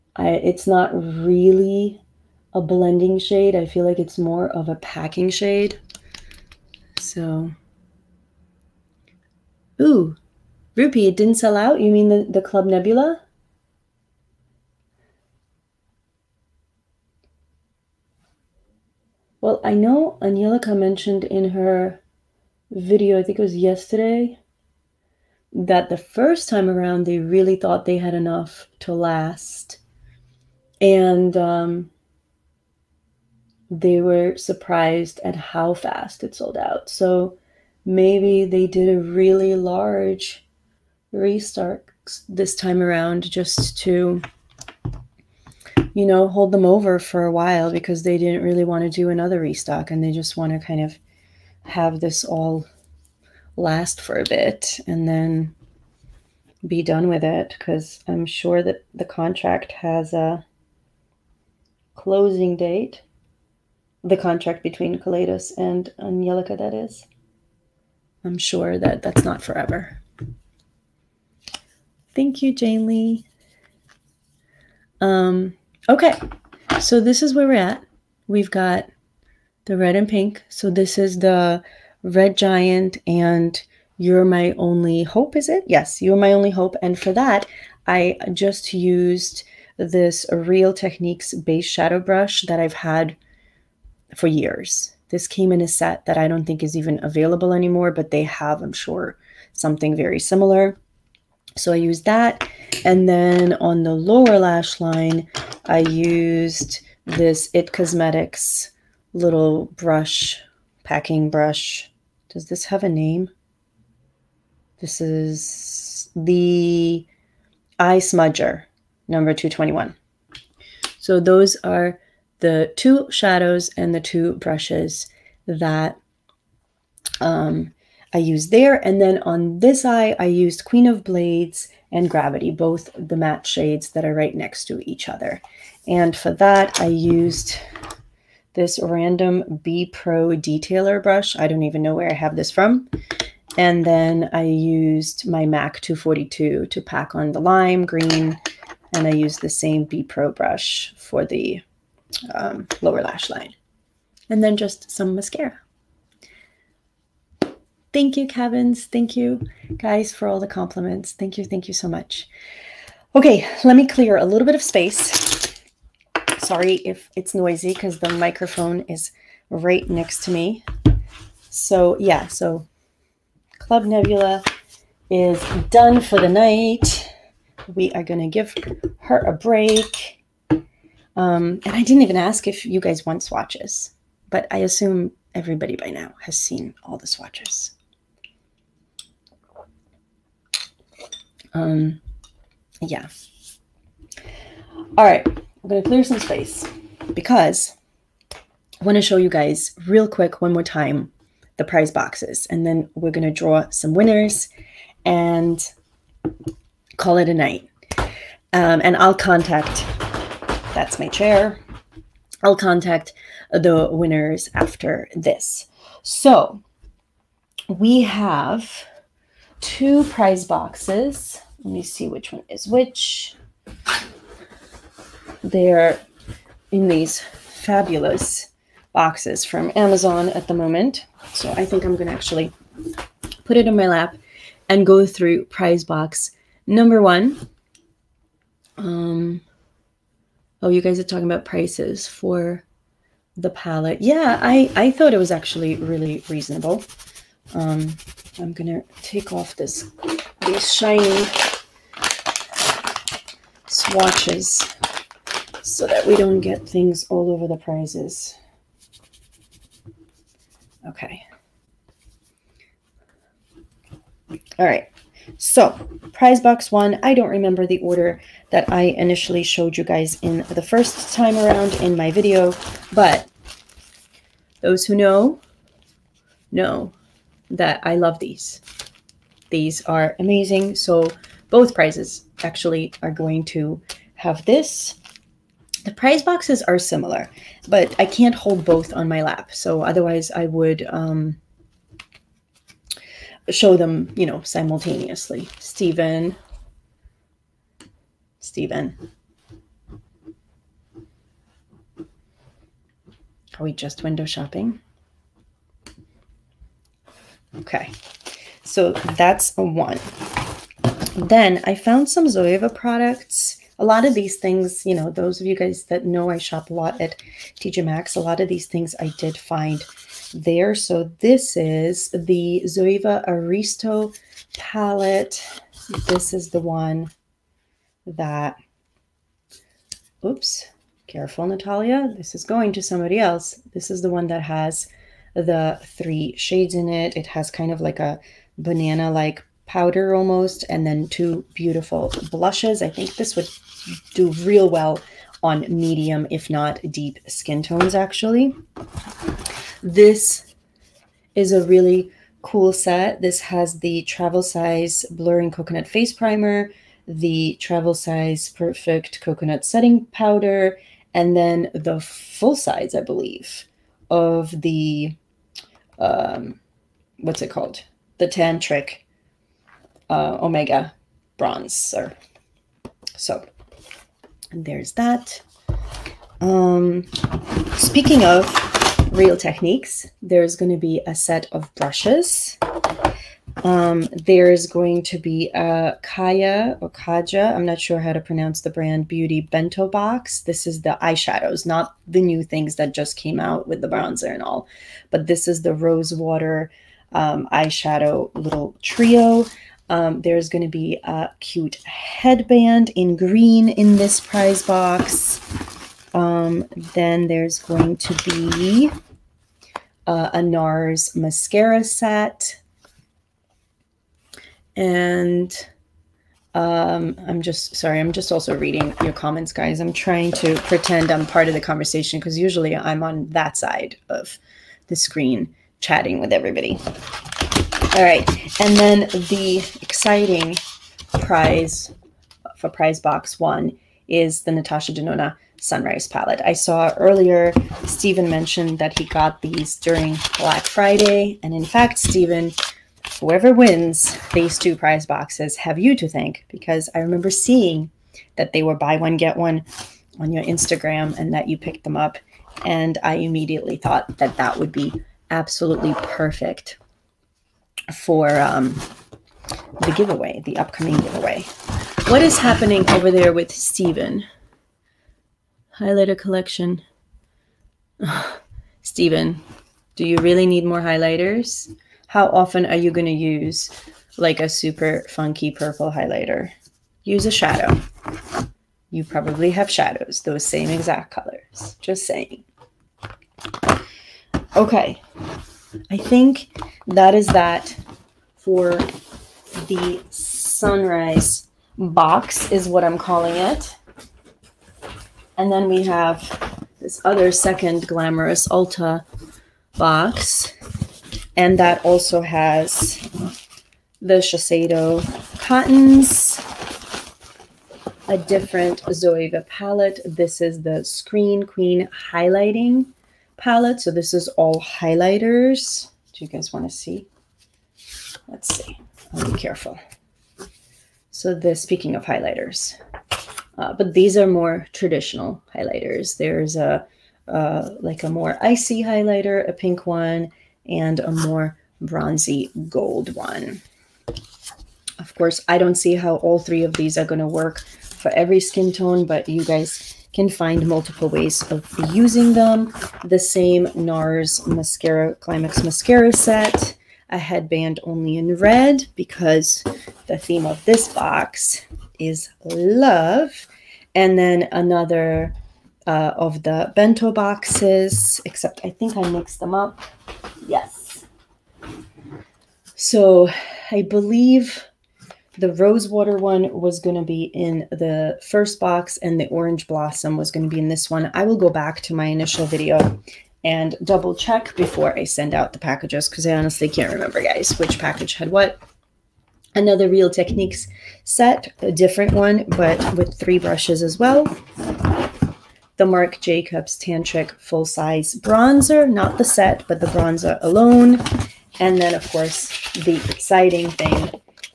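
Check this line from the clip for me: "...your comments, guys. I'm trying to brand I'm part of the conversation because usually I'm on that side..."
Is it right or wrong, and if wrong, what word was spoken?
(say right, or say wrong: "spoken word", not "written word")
wrong: "pretend", not "brand".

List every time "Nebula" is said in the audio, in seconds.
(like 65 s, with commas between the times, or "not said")
12 s, 173 s.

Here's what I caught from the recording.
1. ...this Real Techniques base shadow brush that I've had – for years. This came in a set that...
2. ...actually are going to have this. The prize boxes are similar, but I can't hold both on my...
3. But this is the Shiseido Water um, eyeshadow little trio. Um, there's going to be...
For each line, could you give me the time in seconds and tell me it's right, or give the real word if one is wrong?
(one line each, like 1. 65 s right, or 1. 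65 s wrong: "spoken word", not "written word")
1. 89 s right
2. 282 s right
3. 395 s wrong: "Rose", not "Shiseido".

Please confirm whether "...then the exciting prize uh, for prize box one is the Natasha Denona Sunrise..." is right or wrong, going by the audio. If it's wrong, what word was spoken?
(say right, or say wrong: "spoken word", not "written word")
right.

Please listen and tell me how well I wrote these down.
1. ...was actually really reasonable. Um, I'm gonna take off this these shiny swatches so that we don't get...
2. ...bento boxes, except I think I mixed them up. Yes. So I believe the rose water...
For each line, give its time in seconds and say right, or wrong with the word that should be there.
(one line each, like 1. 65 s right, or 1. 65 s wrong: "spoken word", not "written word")
1. 245 s right
2. 556 s right.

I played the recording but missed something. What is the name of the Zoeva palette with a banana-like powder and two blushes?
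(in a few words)
Aristo.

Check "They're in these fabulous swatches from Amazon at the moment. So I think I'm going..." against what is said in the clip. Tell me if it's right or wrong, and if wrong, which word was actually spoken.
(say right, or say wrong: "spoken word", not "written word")
wrong: "boxes", not "swatches".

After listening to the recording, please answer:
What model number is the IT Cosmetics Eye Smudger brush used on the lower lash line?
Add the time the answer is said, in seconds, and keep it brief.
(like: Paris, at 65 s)
221, at 119 s.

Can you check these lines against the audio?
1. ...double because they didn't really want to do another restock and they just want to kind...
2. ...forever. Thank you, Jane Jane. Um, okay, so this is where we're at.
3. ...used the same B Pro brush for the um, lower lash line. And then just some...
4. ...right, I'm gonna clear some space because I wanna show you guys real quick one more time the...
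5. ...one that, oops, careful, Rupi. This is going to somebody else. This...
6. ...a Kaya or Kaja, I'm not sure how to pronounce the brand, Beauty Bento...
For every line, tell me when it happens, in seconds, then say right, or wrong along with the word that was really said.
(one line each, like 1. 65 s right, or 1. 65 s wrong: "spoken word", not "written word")
1. 47 s wrong: "while", not "double"
2. 69 s wrong: "Lee", not "Jane"
3. 149 s right
4. 195 s right
5. 326 s wrong: "Natalia", not "Rupi"
6. 385 s right.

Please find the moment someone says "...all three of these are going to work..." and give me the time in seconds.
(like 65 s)
536 s.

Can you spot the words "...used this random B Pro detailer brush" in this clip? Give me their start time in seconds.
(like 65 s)
136 s.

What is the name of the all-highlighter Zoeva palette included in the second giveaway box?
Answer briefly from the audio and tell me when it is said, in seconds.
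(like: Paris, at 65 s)
Screen Queen, at 510 s.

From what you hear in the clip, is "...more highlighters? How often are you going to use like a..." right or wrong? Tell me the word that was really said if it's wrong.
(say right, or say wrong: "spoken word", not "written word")
right.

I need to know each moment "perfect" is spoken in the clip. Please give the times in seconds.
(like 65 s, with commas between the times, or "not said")
358 s, 456 s.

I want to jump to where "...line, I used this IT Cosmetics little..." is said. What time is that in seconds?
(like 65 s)
104 s.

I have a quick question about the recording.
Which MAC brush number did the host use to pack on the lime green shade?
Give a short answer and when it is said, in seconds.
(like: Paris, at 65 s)
242, at 145 s.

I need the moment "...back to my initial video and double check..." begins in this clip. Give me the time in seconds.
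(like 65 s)
571 s.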